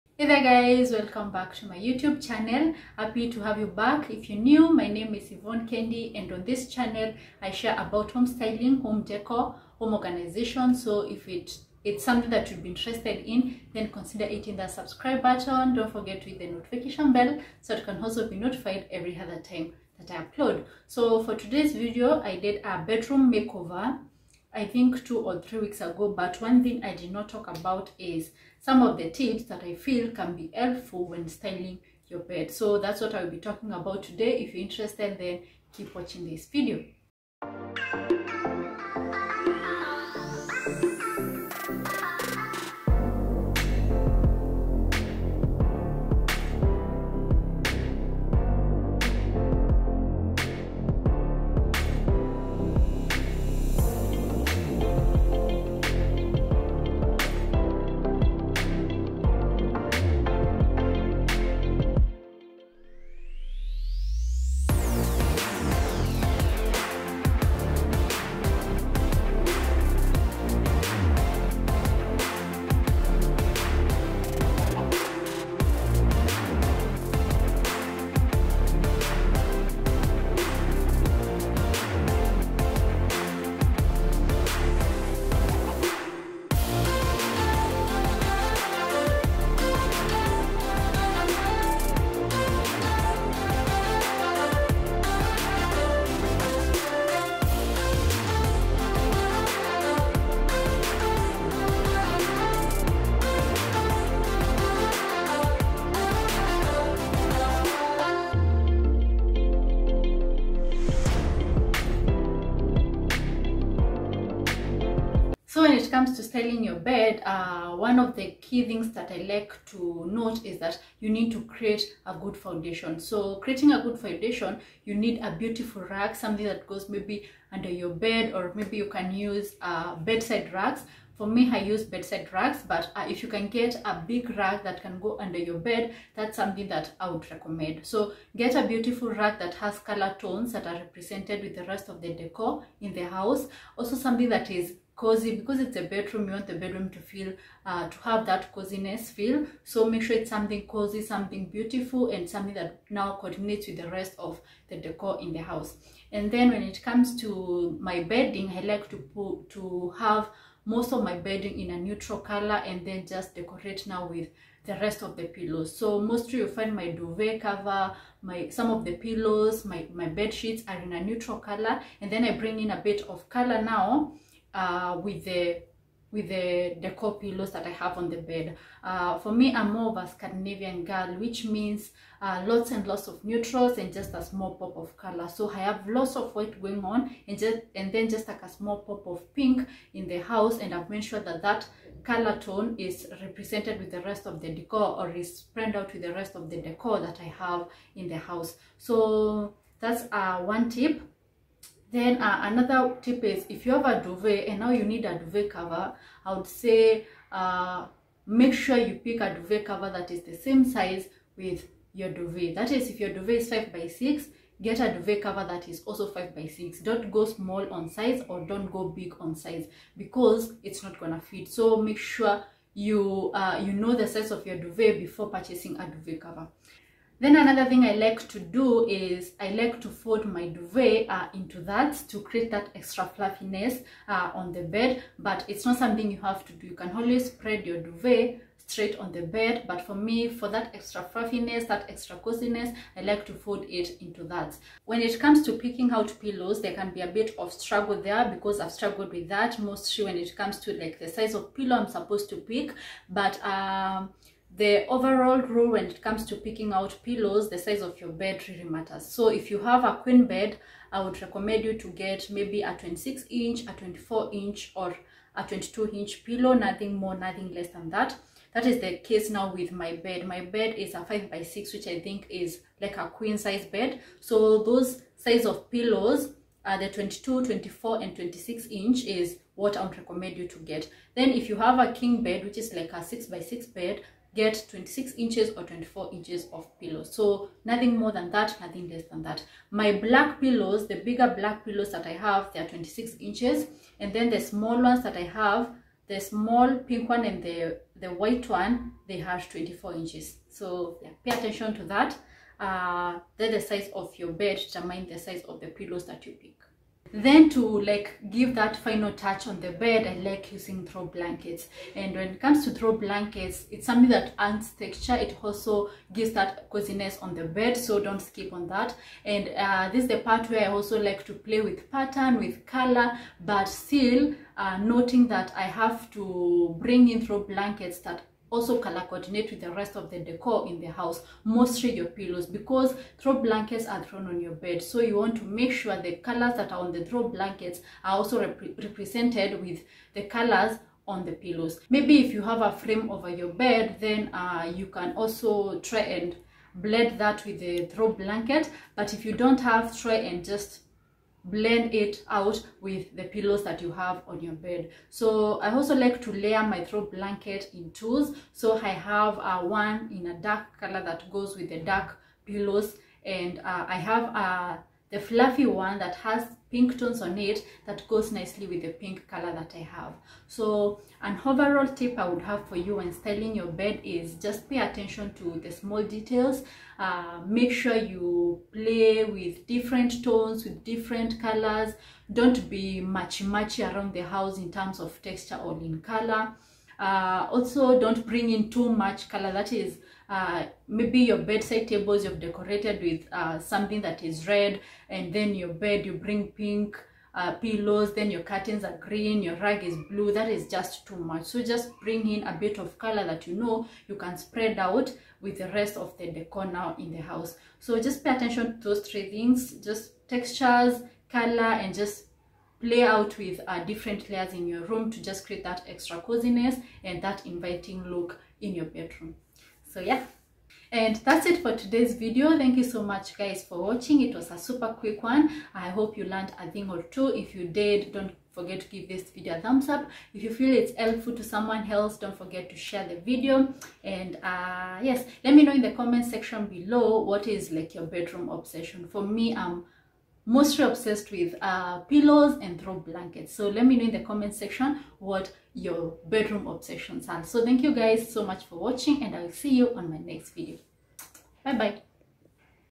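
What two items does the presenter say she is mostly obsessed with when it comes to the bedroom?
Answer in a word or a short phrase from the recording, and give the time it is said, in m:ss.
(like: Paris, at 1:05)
Pillows and throw blankets, at 7:22.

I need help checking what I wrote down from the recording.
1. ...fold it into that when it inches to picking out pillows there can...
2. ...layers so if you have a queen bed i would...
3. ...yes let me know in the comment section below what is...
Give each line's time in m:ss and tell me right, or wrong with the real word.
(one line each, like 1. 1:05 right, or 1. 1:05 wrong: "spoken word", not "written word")
1. 4:03 wrong: "comes", not "inches"
2. 4:18 wrong: "matters", not "layers"
3. 7:15 right.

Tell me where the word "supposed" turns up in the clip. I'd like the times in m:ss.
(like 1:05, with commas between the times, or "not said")
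4:11.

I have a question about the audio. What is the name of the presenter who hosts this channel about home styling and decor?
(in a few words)
Yvonne Kendi.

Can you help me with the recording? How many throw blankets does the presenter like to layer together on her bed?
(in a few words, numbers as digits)
2.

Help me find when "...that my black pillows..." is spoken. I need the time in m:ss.
4:49.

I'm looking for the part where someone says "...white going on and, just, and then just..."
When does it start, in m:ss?
3:06.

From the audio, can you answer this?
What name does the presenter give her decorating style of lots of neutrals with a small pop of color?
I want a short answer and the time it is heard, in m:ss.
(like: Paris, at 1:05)
Scandinavian, at 3:00.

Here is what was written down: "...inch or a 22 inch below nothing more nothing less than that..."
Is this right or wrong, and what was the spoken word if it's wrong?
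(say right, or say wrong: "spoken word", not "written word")
wrong: "pillow", not "below".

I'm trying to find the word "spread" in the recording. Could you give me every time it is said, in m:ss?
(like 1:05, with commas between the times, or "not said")
3:15, 3:57, 6:44.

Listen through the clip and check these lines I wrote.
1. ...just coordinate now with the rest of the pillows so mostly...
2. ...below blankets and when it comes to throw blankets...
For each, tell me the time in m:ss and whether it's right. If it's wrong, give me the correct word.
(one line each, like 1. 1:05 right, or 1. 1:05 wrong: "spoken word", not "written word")
1. 2:43 wrong: "decorate", not "coordinate"
2. 5:10 wrong: "throw", not "below".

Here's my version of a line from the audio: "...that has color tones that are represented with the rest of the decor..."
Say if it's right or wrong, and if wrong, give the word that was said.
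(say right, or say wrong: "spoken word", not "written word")
right.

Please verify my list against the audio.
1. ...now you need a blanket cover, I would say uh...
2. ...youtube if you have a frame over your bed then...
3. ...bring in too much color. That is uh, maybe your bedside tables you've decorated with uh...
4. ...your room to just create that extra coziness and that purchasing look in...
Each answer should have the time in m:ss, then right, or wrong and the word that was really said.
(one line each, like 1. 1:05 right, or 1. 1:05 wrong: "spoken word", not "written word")
1. 3:24 wrong: "duvet", not "blanket"
2. 5:41 wrong: "maybe", not "youtube"
3. 6:28 right
4. 6:54 wrong: "inviting", not "purchasing".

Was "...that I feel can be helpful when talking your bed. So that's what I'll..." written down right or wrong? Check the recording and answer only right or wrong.
wrong.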